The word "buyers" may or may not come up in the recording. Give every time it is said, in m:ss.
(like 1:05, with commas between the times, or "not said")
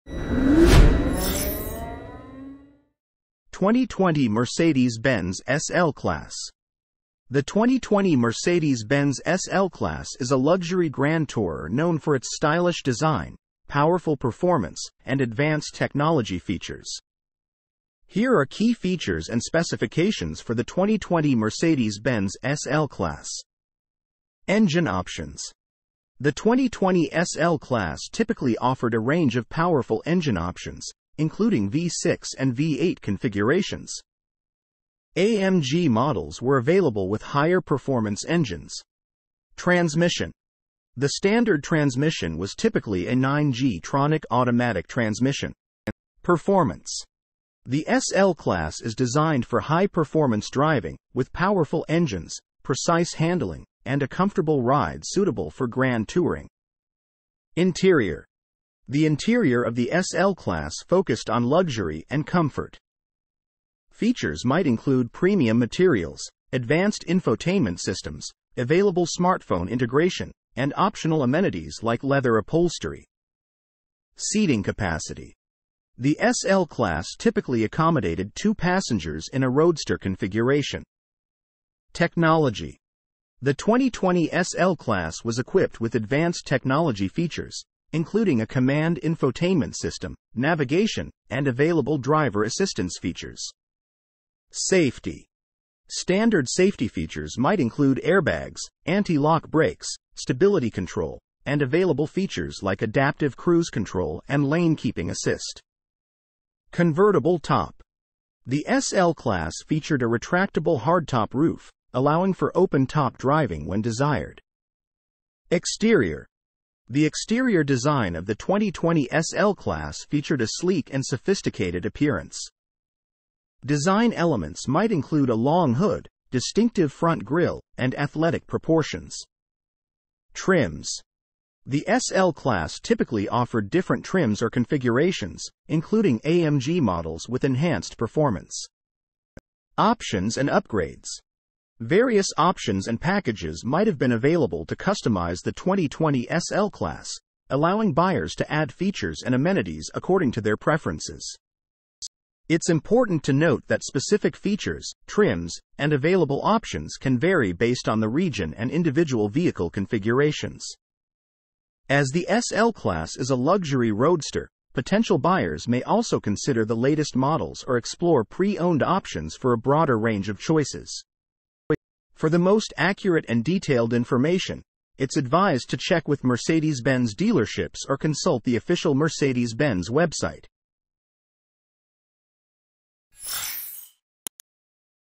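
2:27, 2:45.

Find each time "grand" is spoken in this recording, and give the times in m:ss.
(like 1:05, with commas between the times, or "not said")
0:10, 0:55.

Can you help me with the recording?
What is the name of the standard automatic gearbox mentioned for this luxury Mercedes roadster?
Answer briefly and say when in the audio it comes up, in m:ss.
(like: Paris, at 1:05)
9G Tronic, at 0:43.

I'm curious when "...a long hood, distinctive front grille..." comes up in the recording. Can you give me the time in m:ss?
2:05.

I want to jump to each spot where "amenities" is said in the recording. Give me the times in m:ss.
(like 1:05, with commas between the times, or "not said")
1:11, 2:29.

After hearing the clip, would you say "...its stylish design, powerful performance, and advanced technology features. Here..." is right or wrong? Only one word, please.
right.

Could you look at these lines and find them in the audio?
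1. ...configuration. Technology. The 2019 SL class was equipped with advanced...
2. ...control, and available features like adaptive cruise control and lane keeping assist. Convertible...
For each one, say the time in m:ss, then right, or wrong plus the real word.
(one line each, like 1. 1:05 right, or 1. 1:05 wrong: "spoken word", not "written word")
1. 1:19 wrong: "2020", not "2019"
2. 1:40 right.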